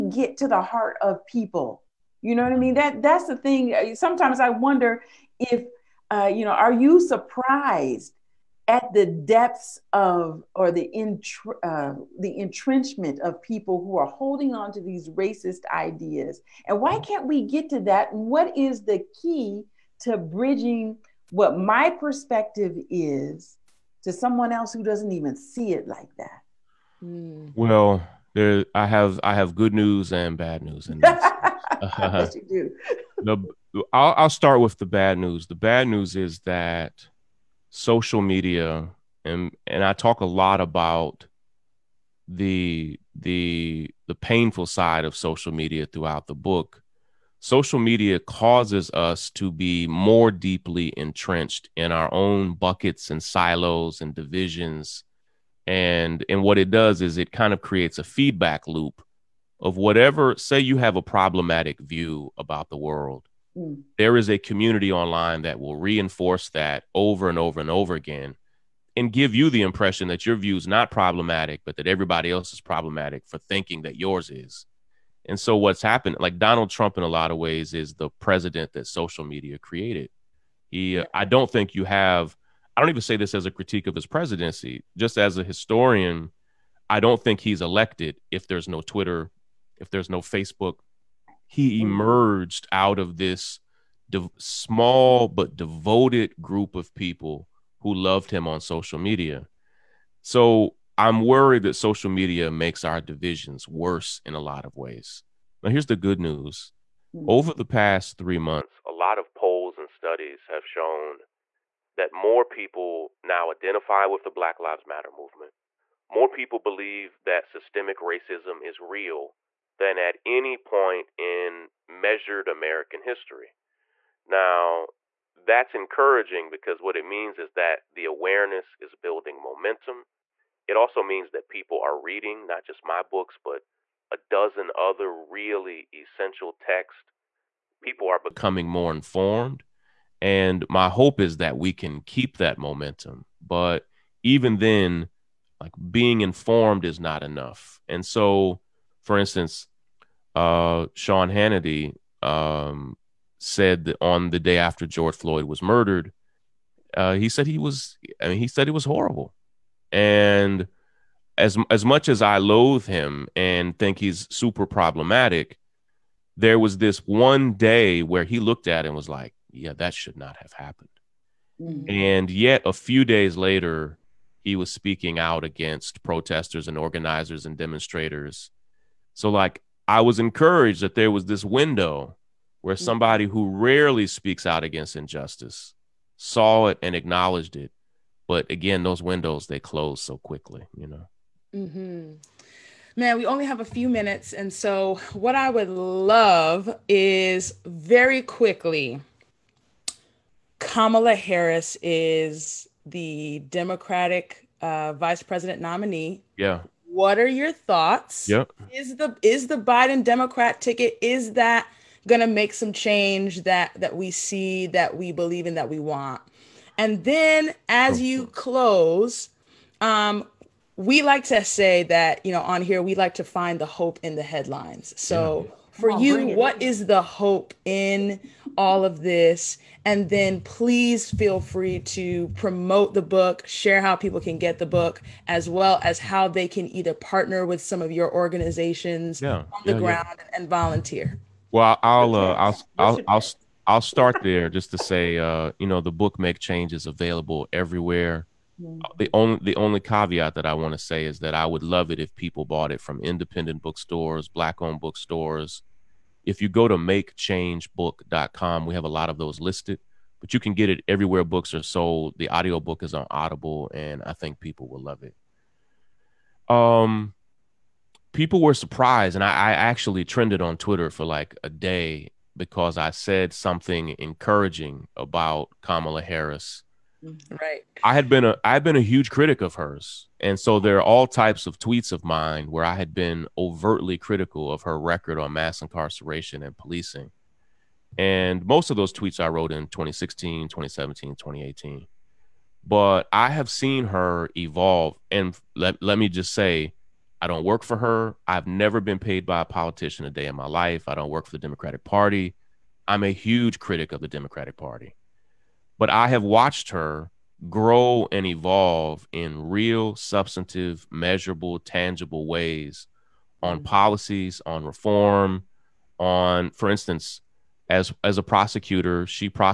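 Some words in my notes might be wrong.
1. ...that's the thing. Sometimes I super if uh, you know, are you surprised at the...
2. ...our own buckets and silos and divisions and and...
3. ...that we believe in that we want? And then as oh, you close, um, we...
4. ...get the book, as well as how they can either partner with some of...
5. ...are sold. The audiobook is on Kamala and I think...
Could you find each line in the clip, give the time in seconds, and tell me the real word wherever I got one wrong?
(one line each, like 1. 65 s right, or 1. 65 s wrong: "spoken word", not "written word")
1. 3 s wrong: "wonder", not "super"
2. 51 s right
3. 214 s right
4. 234 s right
5. 261 s wrong: "Audible", not "Kamala".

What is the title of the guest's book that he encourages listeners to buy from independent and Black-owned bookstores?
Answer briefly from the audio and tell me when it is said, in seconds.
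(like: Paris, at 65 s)
Make Change, at 246 s.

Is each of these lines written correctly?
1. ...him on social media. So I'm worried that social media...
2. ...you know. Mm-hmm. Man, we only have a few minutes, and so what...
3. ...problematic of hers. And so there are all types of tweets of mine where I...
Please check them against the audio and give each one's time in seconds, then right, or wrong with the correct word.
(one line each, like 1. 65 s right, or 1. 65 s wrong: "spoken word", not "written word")
1. 98 s right
2. 190 s right
3. 279 s wrong: "critic", not "problematic".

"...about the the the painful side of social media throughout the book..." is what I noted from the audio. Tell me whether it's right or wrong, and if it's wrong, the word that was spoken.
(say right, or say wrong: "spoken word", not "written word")
right.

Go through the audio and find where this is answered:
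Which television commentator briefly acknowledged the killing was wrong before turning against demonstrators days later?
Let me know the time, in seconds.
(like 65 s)
150 s.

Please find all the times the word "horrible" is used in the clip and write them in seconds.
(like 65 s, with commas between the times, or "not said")
158 s.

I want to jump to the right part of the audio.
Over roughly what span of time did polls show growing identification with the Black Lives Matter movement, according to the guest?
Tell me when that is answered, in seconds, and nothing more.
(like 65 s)
108 s.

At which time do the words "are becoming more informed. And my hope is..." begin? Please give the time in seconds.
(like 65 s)
138 s.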